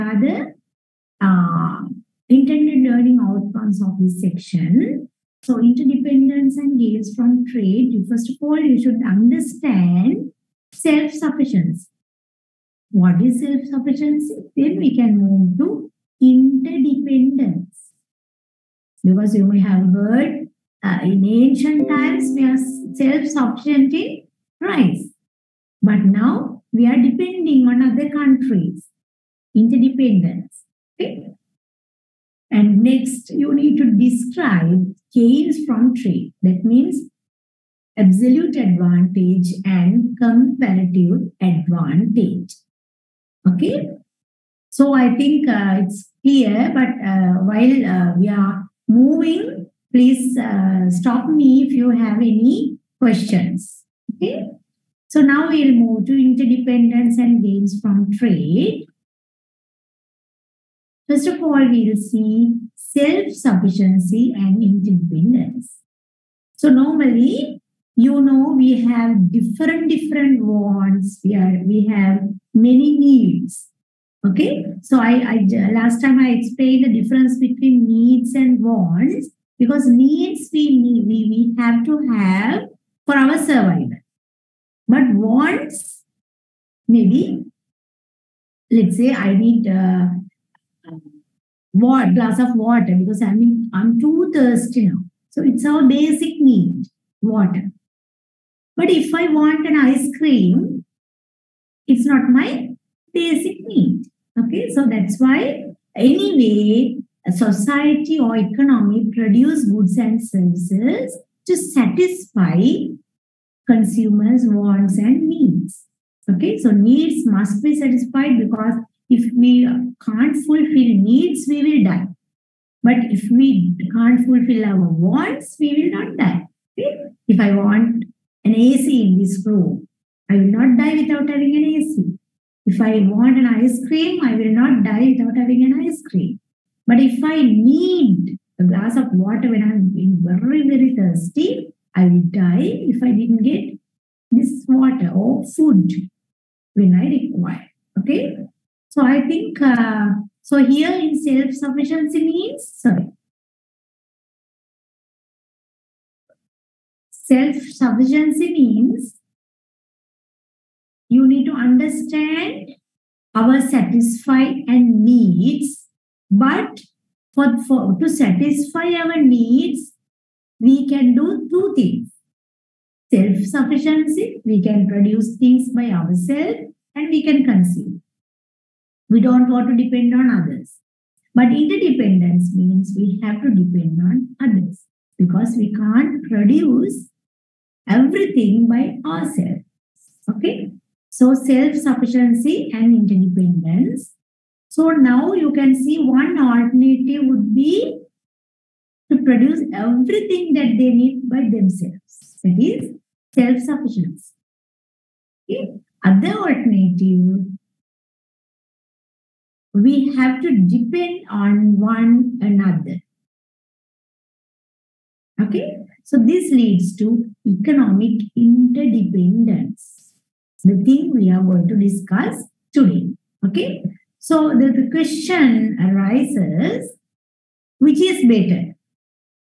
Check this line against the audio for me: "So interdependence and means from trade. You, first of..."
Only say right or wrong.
wrong.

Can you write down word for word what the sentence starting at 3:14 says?
So now you can see one alternative would be to produce everything that they need by themselves.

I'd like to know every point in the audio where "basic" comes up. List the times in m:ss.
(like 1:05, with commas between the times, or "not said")
1:35, 1:43.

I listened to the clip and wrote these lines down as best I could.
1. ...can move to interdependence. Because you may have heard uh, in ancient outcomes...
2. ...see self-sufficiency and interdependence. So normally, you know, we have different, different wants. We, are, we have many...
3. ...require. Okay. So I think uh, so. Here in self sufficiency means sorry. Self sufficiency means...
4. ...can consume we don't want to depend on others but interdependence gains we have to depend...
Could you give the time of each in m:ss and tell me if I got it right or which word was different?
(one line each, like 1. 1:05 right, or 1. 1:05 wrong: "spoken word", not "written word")
1. 0:14 wrong: "times", not "outcomes"
2. 1:01 right
3. 2:27 right
4. 2:57 wrong: "means", not "gains".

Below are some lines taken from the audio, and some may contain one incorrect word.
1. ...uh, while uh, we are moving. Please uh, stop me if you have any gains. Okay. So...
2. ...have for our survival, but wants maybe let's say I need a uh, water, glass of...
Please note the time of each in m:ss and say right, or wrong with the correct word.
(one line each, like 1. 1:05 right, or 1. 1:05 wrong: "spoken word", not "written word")
1. 0:47 wrong: "questions", not "gains"
2. 1:22 right.